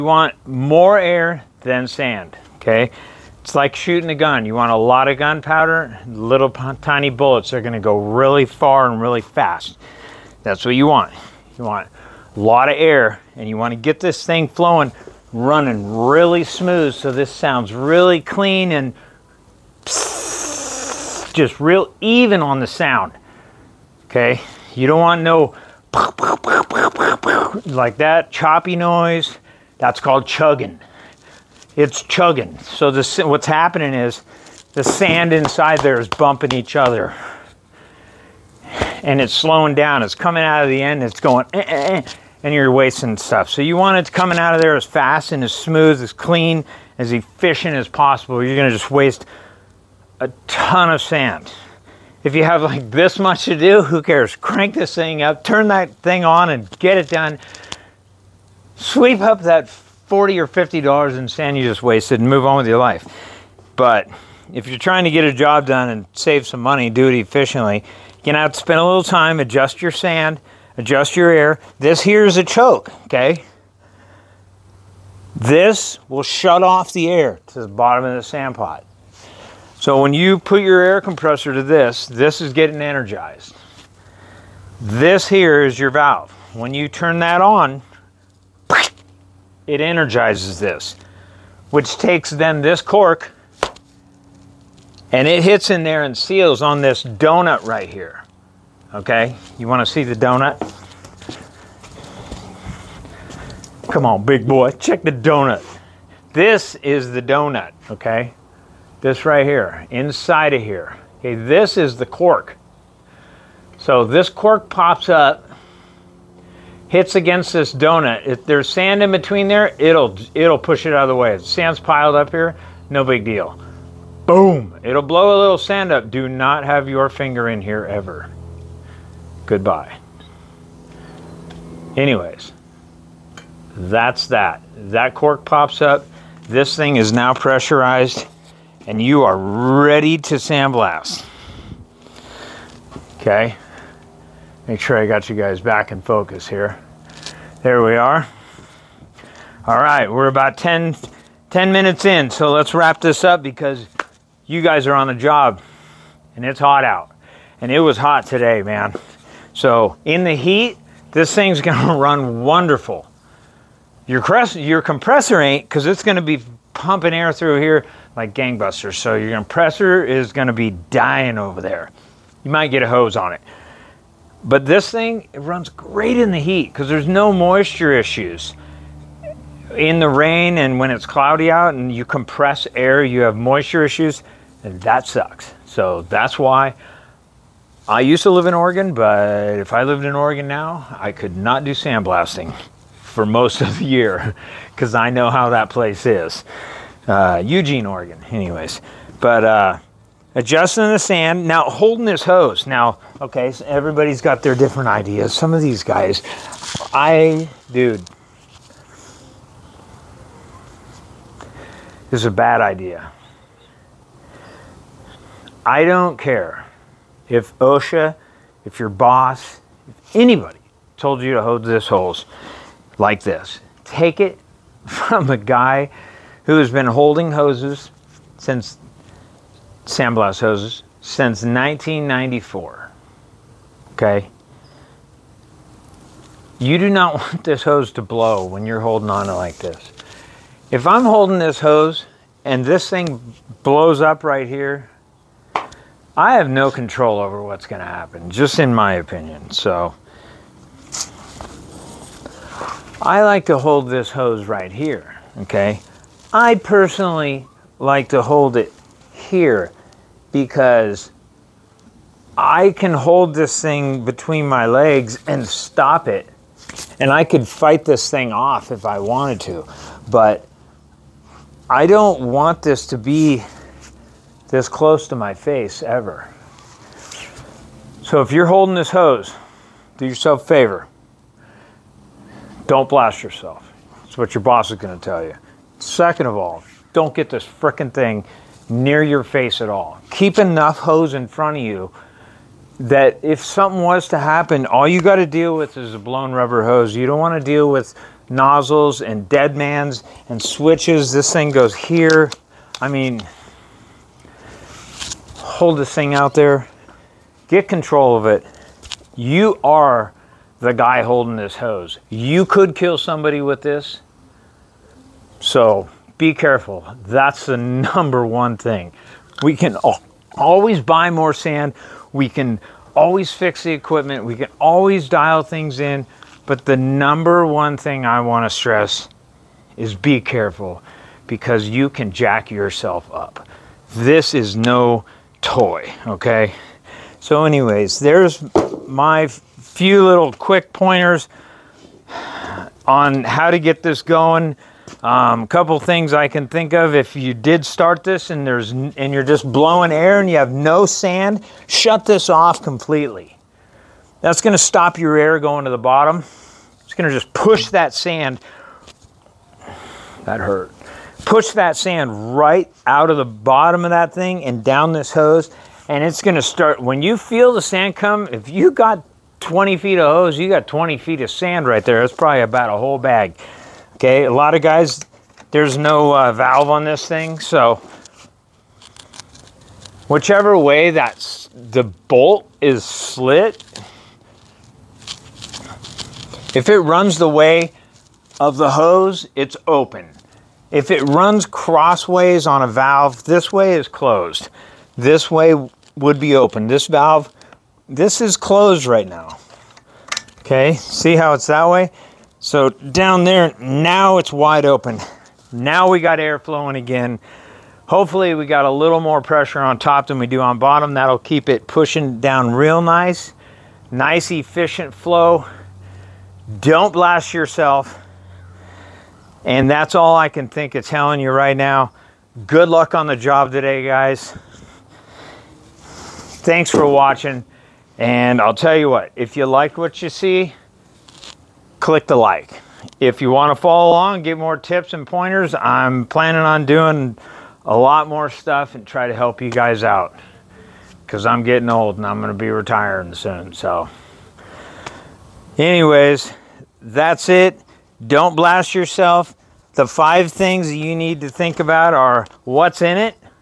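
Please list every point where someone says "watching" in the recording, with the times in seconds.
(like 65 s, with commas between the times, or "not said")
426 s.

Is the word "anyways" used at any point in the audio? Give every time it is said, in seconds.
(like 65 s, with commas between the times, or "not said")
131 s, 198 s, 337 s, 445 s.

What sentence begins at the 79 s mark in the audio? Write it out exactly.
So when you put your air compressor to this, this is getting energized.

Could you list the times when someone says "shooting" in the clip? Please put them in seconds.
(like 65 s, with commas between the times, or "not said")
3 s.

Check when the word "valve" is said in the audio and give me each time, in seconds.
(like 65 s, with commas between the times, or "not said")
85 s, 376 s, 392 s, 396 s.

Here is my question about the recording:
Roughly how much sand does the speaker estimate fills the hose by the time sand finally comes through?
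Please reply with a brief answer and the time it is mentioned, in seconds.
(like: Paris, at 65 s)
A whole bag, at 372 s.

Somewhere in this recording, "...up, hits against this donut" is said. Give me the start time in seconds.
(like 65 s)
115 s.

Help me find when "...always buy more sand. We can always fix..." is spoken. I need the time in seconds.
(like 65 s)
320 s.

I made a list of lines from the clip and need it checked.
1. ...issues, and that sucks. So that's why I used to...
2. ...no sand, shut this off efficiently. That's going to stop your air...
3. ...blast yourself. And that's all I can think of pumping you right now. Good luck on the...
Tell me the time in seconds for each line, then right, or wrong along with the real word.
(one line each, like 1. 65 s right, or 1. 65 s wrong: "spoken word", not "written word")
1. 183 s right
2. 350 s wrong: "completely", not "efficiently"
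3. 416 s wrong: "telling", not "pumping".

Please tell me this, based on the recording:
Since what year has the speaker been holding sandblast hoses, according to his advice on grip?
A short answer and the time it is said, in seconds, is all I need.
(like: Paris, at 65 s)
1994, at 231 s.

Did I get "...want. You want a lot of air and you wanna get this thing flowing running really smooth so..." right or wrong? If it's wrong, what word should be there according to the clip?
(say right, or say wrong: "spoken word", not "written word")
right.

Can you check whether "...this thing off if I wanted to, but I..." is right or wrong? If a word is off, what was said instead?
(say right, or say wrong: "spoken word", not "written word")
right.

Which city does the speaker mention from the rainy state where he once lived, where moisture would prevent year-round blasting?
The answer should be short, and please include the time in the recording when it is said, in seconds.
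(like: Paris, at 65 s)
Eugene, Oregon, at 197 s.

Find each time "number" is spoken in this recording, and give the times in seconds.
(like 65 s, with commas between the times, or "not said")
317 s, 326 s.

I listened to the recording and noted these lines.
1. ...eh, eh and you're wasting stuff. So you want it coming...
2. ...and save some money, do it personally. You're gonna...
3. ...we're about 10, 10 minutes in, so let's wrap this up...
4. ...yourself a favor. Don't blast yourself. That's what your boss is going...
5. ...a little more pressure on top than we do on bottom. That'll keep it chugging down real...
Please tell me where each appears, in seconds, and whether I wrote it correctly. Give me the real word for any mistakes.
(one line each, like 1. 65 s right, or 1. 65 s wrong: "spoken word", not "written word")
1. 41 s right
2. 65 s wrong: "efficiently", not "personally"
3. 150 s right
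4. 280 s right
5. 408 s wrong: "pushing", not "chugging".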